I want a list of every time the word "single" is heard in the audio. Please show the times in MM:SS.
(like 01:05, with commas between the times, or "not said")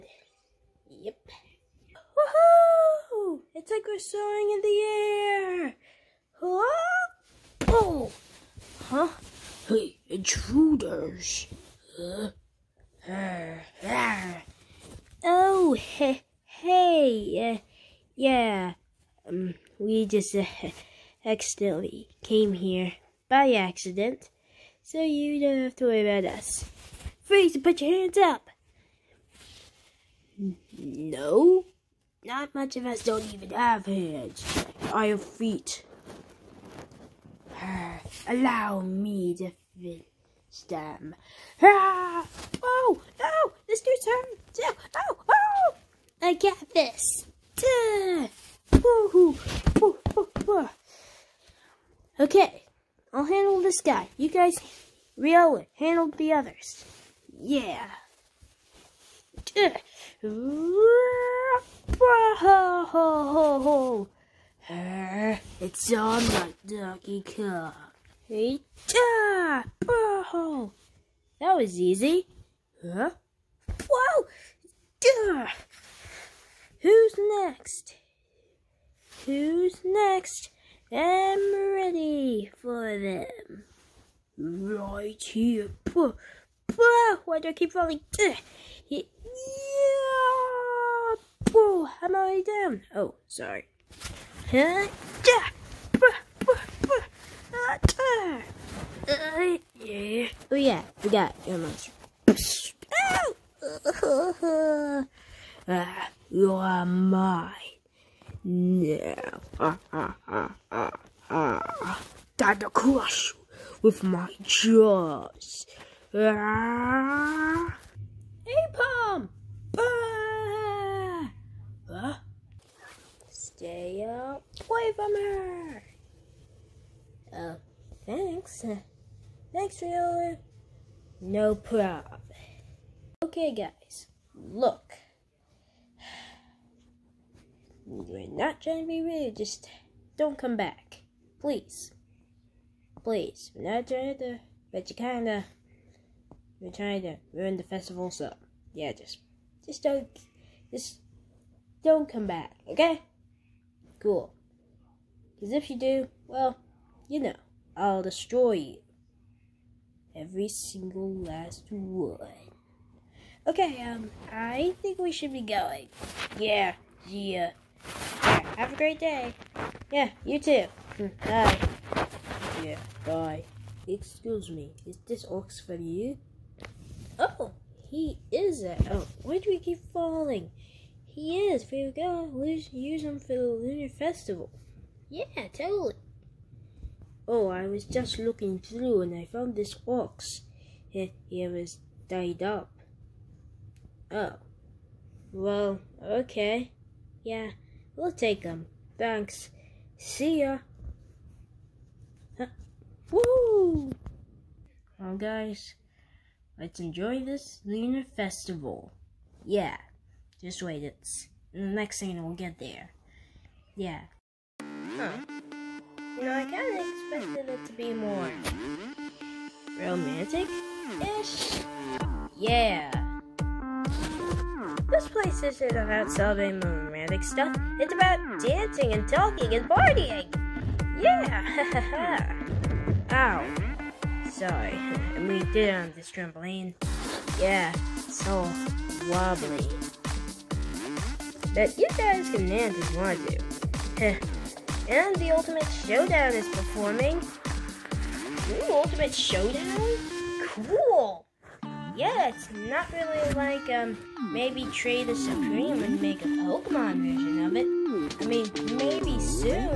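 02:40.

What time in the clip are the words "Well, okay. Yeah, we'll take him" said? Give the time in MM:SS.
03:15.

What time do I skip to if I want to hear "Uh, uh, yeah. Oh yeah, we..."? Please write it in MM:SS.
01:39.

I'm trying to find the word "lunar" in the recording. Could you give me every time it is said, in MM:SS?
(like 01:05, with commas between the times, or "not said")
03:03, 03:27.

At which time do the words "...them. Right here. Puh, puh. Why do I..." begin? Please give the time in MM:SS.
01:22.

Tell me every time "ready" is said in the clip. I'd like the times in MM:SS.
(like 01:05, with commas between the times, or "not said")
01:21.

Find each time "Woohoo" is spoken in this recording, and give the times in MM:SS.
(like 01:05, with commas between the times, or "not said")
00:01, 00:48.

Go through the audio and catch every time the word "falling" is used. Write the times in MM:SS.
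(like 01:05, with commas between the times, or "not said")
01:27, 02:59.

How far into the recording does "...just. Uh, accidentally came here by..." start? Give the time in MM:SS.
00:20.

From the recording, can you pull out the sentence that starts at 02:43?
Okay, um, I think we should be going.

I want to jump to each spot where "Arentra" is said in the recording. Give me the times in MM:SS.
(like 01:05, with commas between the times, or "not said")
not said.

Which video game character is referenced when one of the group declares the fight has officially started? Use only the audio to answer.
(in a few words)
Donkey Kong.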